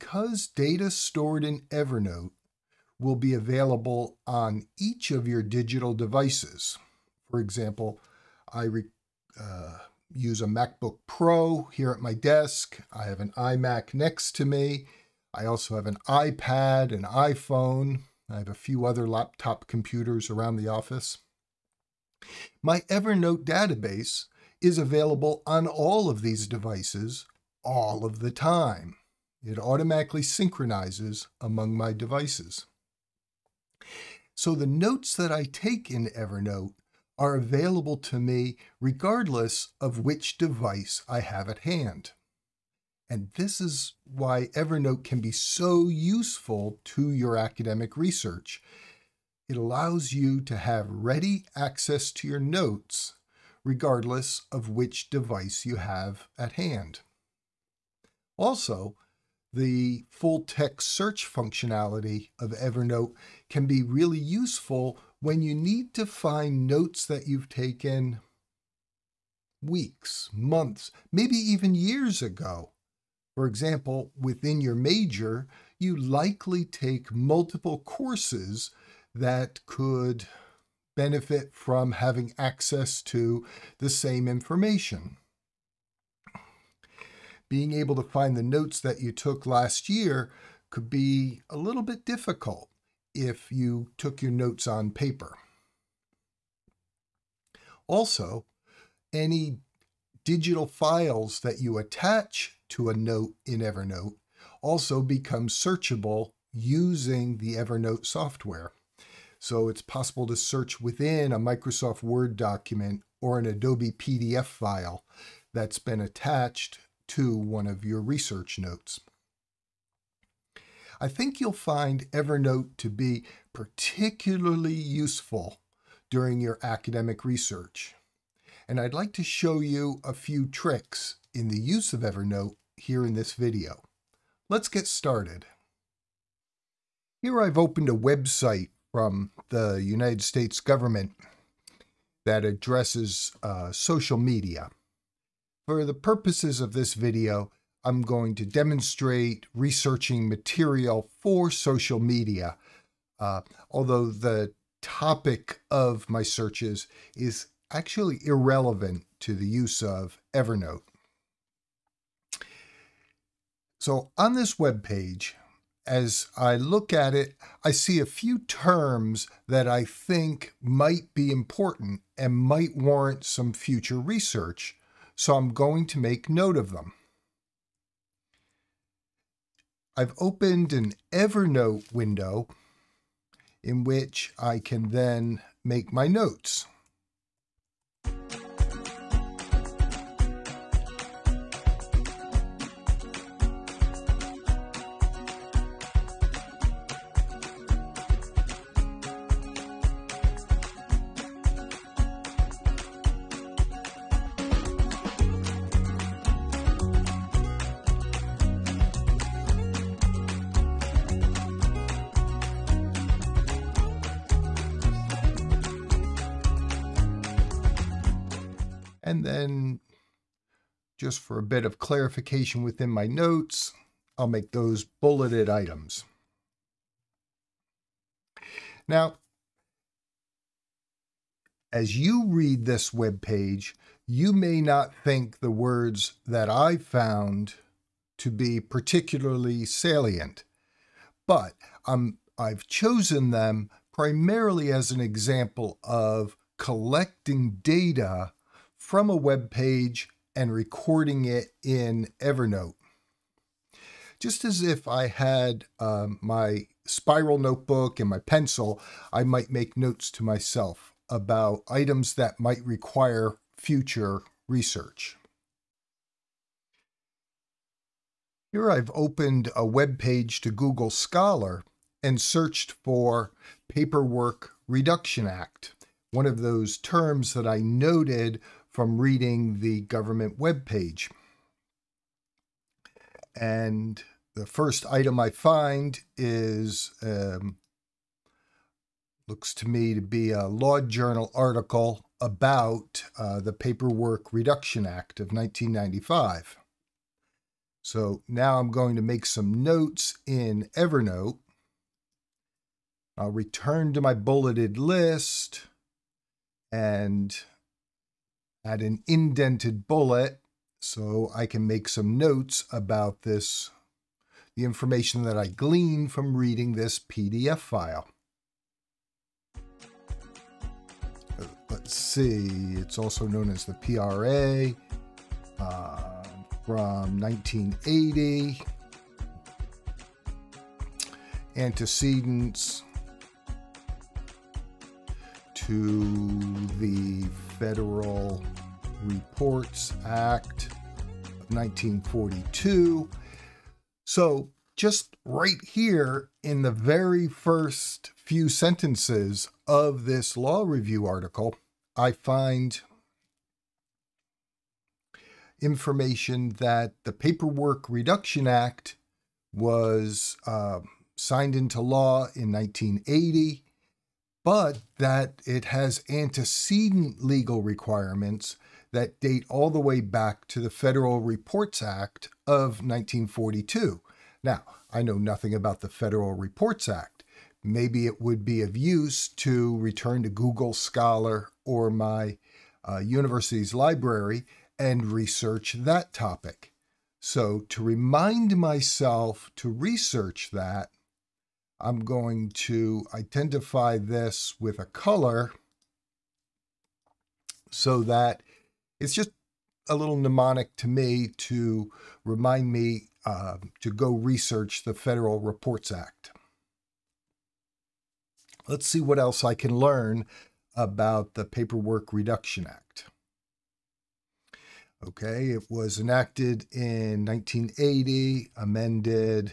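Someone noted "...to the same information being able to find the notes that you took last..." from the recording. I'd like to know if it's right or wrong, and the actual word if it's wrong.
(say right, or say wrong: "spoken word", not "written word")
right.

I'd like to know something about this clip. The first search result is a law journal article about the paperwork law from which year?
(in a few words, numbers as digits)
1995.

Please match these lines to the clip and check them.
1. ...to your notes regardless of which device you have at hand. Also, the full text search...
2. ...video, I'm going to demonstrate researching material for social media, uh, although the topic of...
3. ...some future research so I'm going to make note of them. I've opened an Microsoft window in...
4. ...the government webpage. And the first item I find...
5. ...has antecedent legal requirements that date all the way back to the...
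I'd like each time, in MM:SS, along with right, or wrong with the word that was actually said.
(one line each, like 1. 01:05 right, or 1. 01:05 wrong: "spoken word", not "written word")
1. 00:52 right
2. 02:26 right
3. 02:53 wrong: "Evernote", not "Microsoft"
4. 04:39 right
5. 06:05 right.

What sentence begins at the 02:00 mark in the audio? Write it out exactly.
I think you'll find Evernote to be particularly useful during your academic research.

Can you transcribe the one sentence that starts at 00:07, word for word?
For example, I re, uh, use a MacBook Pro here at my desk.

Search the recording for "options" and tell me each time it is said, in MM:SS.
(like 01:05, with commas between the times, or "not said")
not said.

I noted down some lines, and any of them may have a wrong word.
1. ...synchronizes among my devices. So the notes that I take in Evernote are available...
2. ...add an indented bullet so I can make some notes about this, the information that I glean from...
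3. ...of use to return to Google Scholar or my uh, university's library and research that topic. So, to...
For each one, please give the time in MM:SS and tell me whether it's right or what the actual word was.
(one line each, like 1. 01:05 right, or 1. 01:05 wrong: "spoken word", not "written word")
1. 00:30 right
2. 05:08 right
3. 06:18 right.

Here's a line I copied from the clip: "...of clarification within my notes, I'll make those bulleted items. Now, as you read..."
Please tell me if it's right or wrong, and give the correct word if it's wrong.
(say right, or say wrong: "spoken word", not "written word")
right.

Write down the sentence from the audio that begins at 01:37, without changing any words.
Also, any digital files that you attach to a note in Evernote also become searchable using the Evernote software.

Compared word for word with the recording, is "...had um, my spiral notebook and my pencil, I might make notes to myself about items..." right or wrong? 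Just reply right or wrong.
right.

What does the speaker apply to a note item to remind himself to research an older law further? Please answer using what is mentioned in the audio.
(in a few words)
a color.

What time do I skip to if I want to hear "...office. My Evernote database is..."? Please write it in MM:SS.
00:20.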